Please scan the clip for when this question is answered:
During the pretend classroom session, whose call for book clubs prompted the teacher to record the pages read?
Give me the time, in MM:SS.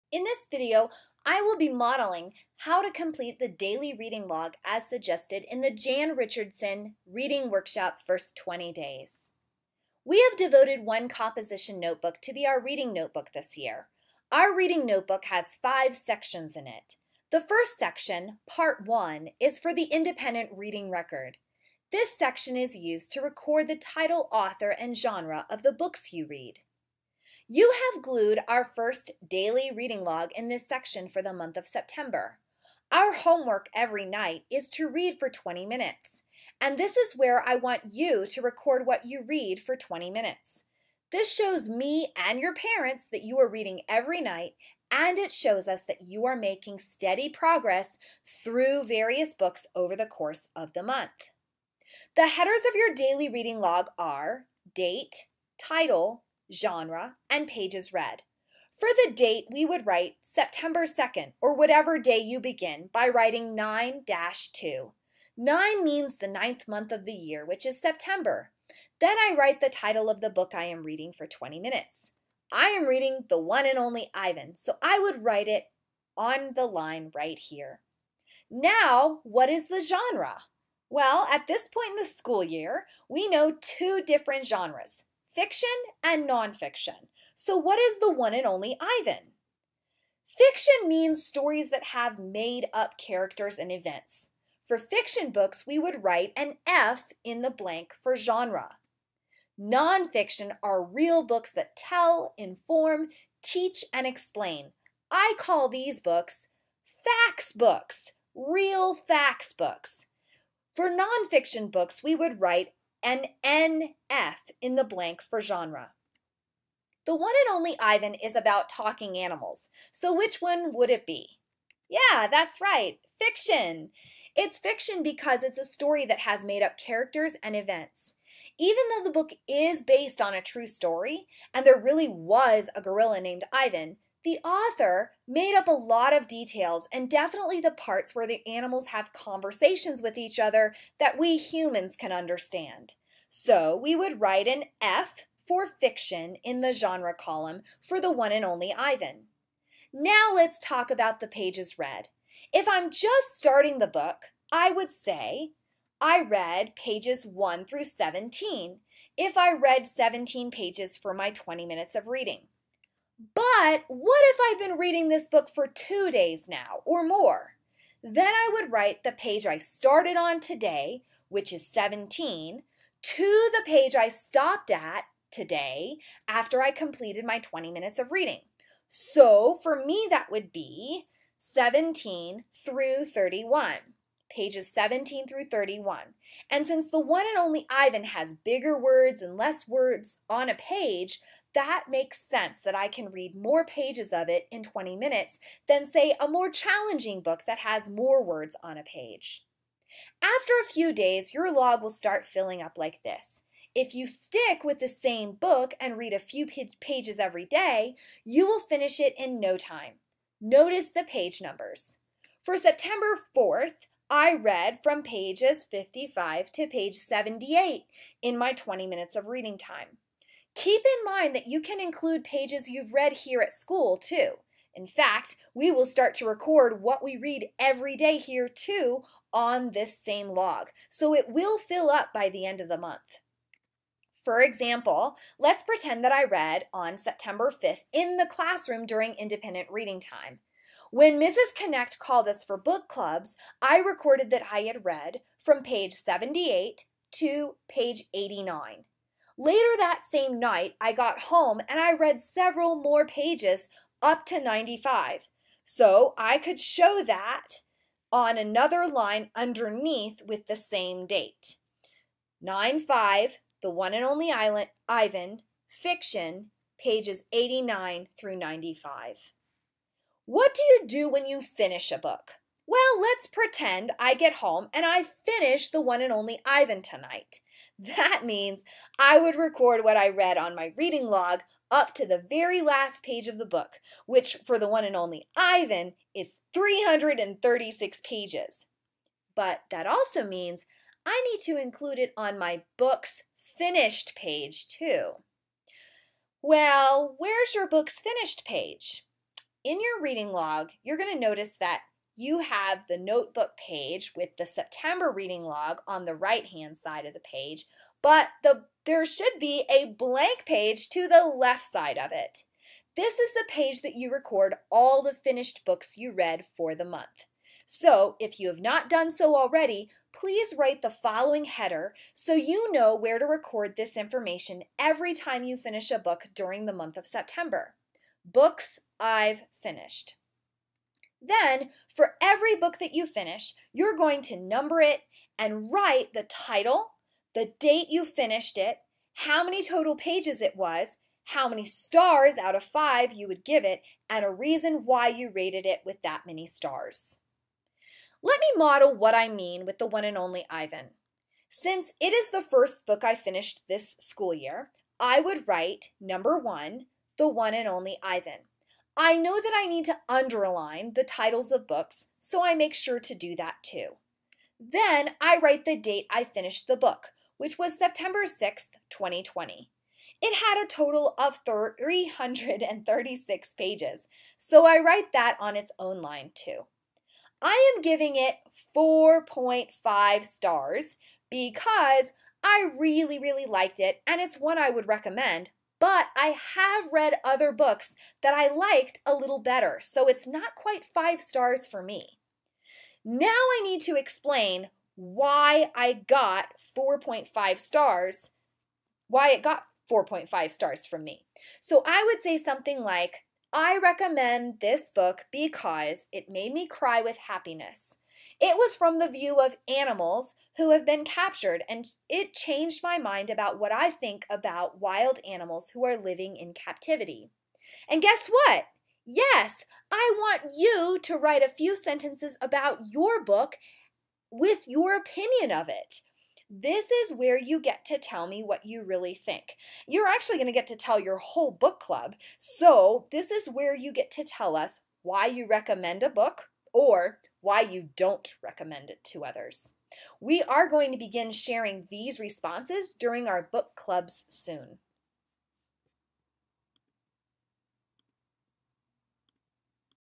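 04:01.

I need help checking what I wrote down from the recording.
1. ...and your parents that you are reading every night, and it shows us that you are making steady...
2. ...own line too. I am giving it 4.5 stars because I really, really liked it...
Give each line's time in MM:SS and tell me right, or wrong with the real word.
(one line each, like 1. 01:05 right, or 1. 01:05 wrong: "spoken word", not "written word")
1. 00:42 right
2. 06:15 right.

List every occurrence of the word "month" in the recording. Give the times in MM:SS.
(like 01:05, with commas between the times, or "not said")
00:31, 00:50, 01:06, 03:52, 05:16, 05:26.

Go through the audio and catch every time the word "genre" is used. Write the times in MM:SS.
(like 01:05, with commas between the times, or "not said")
00:24, 00:56, 01:19, 01:24, 01:38, 01:55, 02:26.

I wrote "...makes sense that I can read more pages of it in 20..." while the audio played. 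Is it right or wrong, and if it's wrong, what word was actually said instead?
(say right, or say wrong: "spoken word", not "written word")
right.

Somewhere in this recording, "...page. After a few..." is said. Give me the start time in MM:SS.
03:18.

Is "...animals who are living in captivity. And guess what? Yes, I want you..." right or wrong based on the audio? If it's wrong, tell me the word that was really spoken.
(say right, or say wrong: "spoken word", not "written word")
right.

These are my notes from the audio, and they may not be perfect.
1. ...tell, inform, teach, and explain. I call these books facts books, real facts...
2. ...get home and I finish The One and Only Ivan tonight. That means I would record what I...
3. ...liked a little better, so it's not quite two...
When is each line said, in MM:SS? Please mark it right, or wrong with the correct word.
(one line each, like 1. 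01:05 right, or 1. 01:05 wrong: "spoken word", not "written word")
1. 01:41 right
2. 04:34 right
3. 06:28 wrong: "five", not "two".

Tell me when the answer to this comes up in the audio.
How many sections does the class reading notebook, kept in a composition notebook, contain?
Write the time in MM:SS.
00:15.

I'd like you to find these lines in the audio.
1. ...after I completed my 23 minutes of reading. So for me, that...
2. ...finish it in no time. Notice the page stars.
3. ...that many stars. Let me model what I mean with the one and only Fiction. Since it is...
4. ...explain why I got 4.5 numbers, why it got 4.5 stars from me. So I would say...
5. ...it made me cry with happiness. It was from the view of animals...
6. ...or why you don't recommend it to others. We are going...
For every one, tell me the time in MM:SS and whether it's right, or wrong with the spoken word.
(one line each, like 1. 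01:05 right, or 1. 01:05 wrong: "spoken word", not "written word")
1. 02:56 wrong: "20", not "23"
2. 03:28 wrong: "numbers", not "stars"
3. 05:46 wrong: "Ivan", not "Fiction"
4. 06:33 wrong: "stars", not "numbers"
5. 06:46 right
6. 07:16 right.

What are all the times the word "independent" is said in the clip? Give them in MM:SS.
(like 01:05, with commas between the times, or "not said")
00:19, 03:59.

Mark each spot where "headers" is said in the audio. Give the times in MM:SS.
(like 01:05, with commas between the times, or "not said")
00:52, 05:21.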